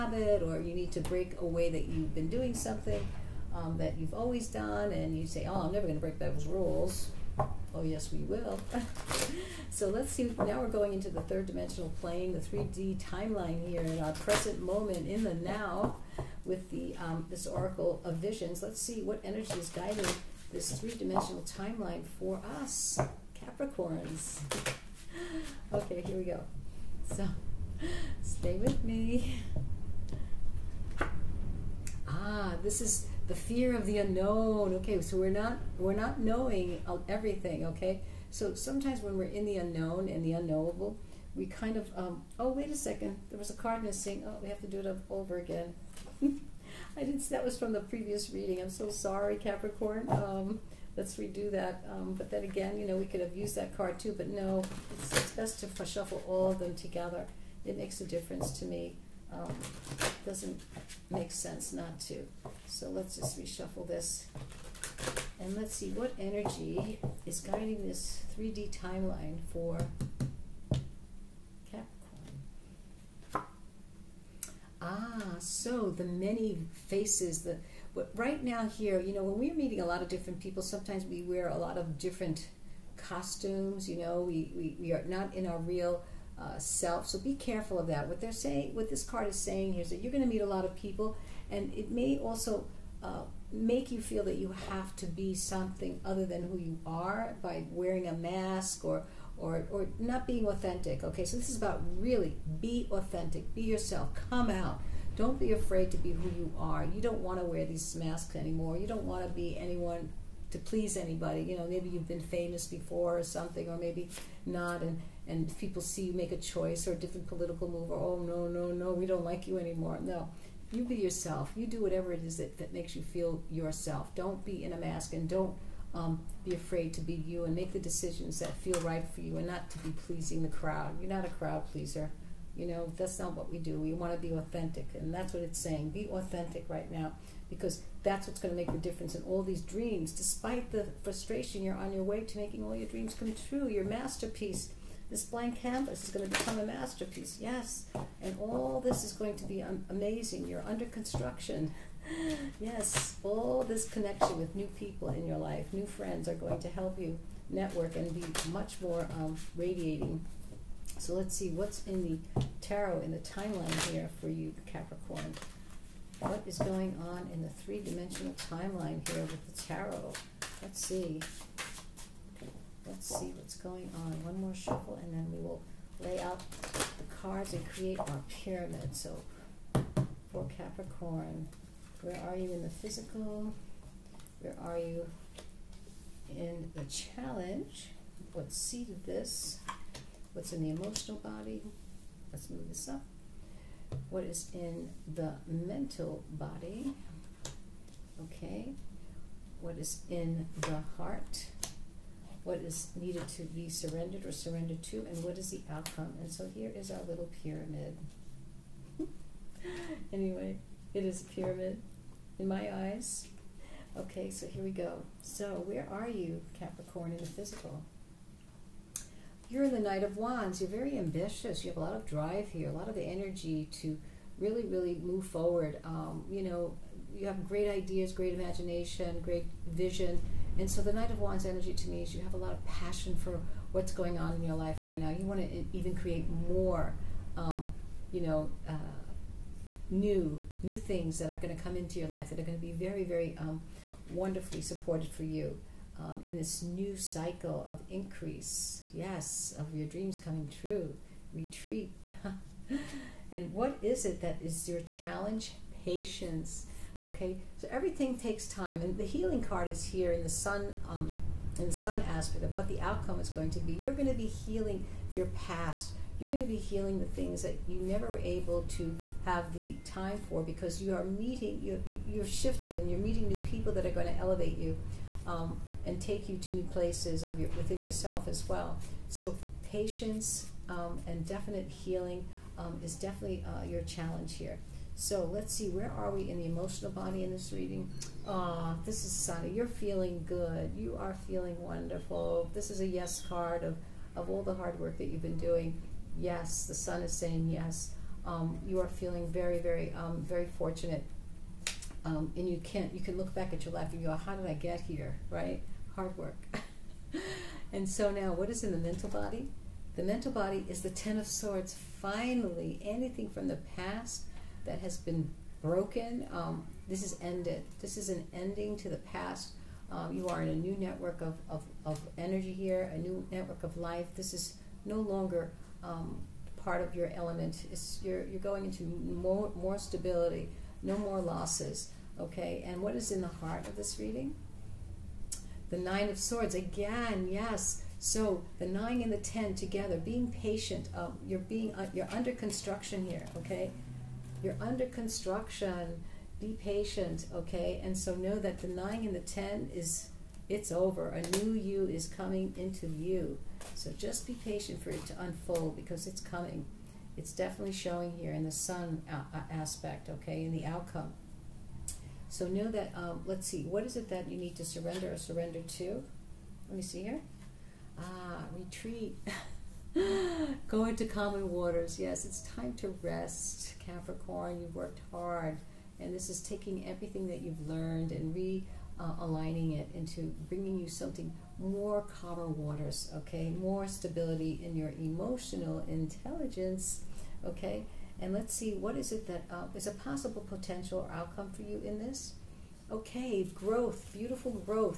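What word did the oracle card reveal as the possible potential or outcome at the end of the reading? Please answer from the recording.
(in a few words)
Growth.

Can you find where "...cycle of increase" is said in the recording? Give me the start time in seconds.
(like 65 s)
246 s.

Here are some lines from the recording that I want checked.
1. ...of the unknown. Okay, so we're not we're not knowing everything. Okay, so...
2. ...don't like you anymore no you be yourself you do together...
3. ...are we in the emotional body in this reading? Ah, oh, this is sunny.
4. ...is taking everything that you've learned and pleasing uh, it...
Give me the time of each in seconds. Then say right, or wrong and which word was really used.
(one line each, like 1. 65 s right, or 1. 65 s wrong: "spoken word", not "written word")
1. 33 s right
2. 119 s wrong: "whatever", not "together"
3. 285 s right
4. 376 s wrong: "realigning", not "pleasing".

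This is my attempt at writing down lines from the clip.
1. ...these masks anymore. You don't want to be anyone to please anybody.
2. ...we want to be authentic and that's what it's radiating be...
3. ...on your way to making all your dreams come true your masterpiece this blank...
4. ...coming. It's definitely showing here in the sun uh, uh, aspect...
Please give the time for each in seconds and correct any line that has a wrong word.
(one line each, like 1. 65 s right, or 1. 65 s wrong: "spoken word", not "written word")
1. 107 s right
2. 133 s wrong: "saying", not "radiating"
3. 141 s right
4. 356 s right.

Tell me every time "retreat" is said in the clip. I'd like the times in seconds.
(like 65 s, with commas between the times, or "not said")
251 s, 368 s.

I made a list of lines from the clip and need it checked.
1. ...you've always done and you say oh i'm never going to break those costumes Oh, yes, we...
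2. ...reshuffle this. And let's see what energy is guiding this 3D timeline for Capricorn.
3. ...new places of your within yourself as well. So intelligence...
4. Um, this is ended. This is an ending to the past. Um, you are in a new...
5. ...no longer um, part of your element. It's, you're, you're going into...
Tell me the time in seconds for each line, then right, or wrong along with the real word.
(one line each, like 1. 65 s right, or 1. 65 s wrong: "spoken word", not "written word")
1. 3 s wrong: "rules", not "costumes"
2. 63 s right
3. 276 s wrong: "patience", not "intelligence"
4. 316 s right
5. 324 s right.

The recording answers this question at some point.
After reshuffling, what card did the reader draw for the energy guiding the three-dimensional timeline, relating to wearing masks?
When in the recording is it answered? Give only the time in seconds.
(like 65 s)
75 s.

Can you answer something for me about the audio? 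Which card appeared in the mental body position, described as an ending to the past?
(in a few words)
Ten of Swords.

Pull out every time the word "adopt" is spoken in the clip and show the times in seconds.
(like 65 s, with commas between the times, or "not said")
not said.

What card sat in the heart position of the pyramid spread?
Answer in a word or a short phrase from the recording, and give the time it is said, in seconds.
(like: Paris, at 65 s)
Nine of Swords, at 335 s.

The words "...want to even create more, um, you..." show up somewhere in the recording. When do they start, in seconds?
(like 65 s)
235 s.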